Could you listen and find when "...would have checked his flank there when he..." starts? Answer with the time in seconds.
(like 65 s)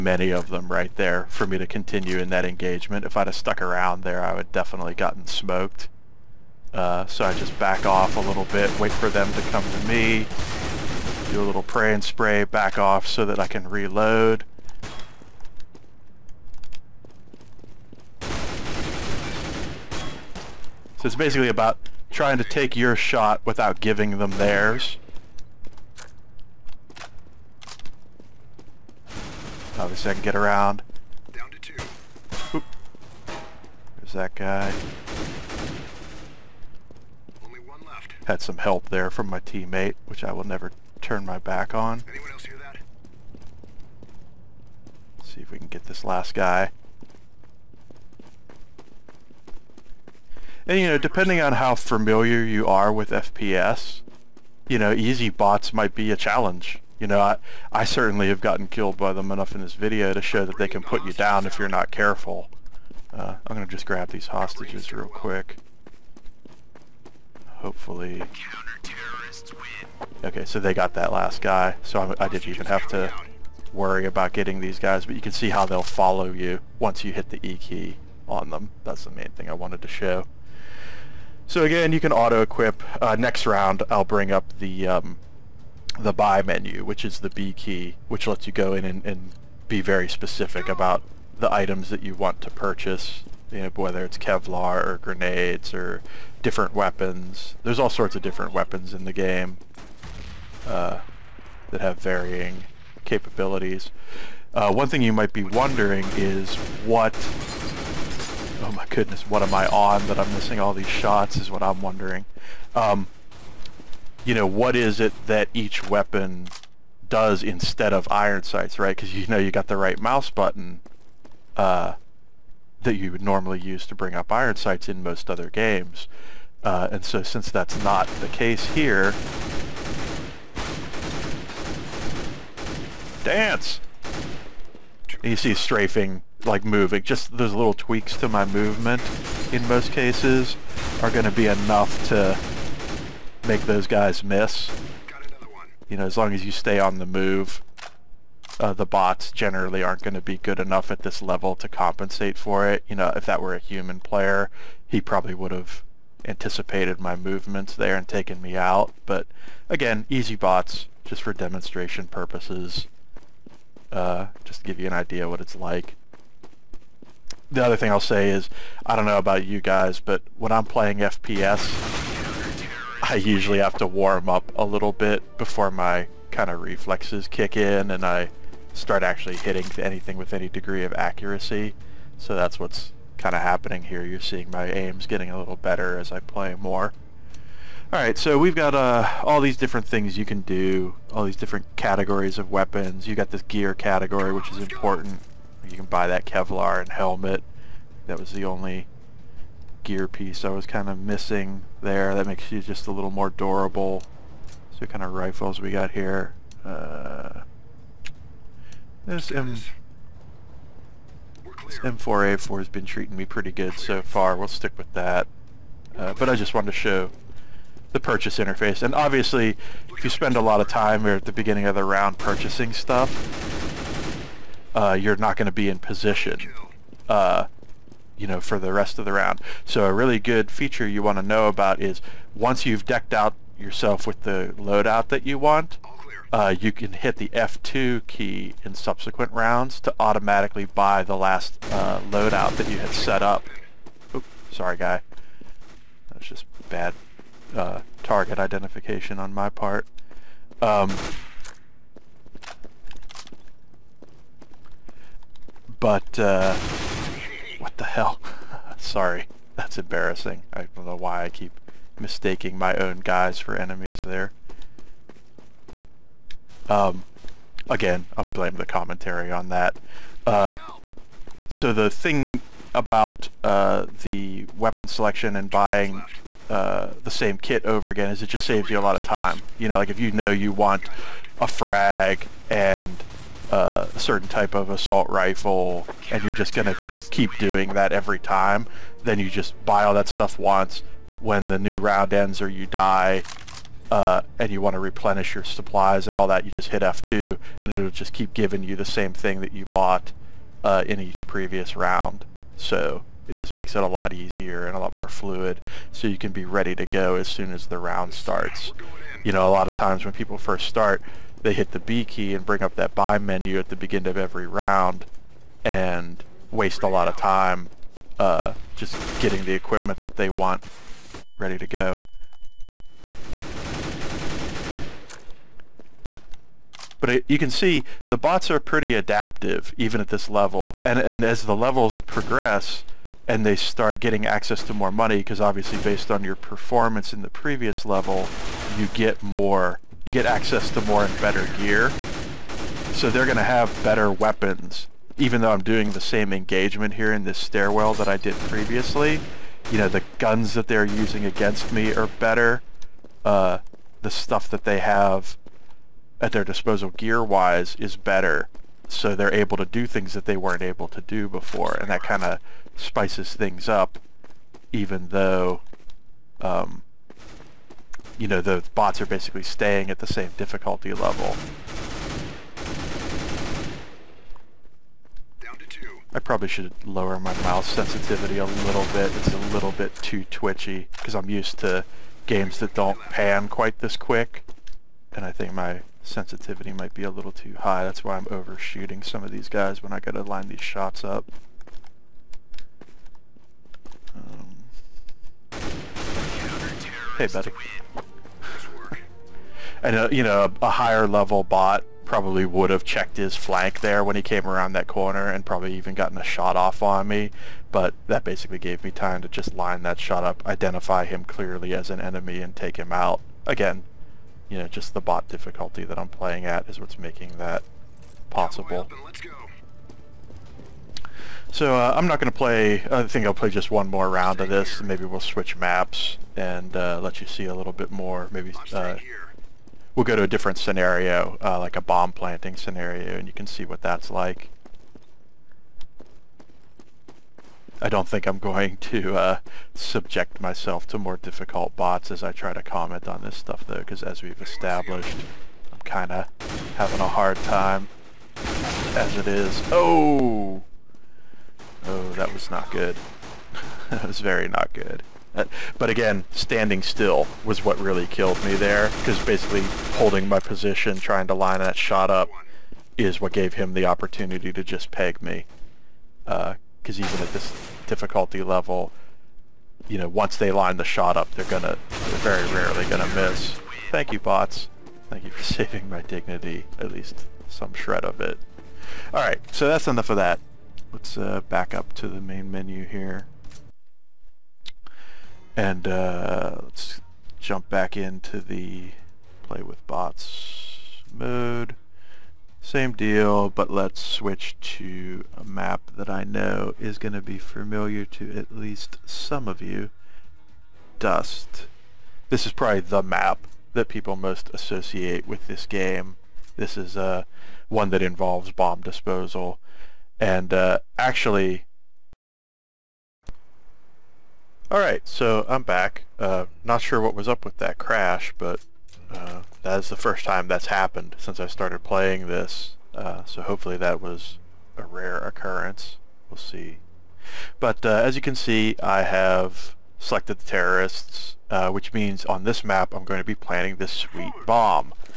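402 s.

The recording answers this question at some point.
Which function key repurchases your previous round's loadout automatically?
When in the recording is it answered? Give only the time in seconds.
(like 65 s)
237 s.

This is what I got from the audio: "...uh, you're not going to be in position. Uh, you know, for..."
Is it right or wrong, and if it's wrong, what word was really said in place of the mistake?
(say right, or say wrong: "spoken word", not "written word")
right.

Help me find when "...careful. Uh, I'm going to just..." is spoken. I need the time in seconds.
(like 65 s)
61 s.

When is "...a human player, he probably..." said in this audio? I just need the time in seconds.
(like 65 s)
153 s.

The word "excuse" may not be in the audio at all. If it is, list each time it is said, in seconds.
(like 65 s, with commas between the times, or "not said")
not said.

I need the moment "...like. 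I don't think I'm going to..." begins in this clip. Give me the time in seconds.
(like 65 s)
434 s.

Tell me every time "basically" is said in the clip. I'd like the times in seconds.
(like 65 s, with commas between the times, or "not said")
21 s, 369 s, 408 s, 459 s.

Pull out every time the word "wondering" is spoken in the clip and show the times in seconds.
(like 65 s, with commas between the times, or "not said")
105 s, 111 s.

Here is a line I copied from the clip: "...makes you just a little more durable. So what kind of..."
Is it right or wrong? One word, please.
right.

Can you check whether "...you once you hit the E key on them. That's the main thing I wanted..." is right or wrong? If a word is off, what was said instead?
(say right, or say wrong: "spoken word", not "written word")
right.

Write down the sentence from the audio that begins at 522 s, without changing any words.
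Uh, so hopefully that was a rare occurrence.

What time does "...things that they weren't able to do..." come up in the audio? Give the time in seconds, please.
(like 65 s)
359 s.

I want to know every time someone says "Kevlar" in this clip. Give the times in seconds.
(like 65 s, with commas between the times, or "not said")
94 s, 196 s.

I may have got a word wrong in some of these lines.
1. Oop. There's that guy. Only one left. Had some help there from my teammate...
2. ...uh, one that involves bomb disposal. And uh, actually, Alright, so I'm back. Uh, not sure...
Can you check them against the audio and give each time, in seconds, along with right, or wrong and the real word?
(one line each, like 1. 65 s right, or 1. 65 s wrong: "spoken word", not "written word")
1. 32 s right
2. 506 s right.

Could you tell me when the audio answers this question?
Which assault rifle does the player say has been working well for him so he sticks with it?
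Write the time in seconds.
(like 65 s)
211 s.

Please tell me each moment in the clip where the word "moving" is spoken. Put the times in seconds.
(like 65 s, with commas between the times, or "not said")
136 s.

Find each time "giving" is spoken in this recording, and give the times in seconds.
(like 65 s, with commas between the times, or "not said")
23 s, 298 s.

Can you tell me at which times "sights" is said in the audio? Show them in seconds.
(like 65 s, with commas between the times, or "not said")
118 s, 124 s.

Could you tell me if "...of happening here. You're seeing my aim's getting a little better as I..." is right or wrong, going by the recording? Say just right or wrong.
right.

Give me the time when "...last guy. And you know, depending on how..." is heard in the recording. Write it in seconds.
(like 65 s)
46 s.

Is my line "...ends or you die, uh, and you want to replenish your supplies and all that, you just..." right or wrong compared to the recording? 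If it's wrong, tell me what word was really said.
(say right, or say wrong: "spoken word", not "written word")
right.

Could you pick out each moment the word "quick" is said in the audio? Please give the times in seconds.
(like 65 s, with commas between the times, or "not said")
65 s, 383 s.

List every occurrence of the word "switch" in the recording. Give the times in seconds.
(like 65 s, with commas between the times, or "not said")
425 s, 494 s.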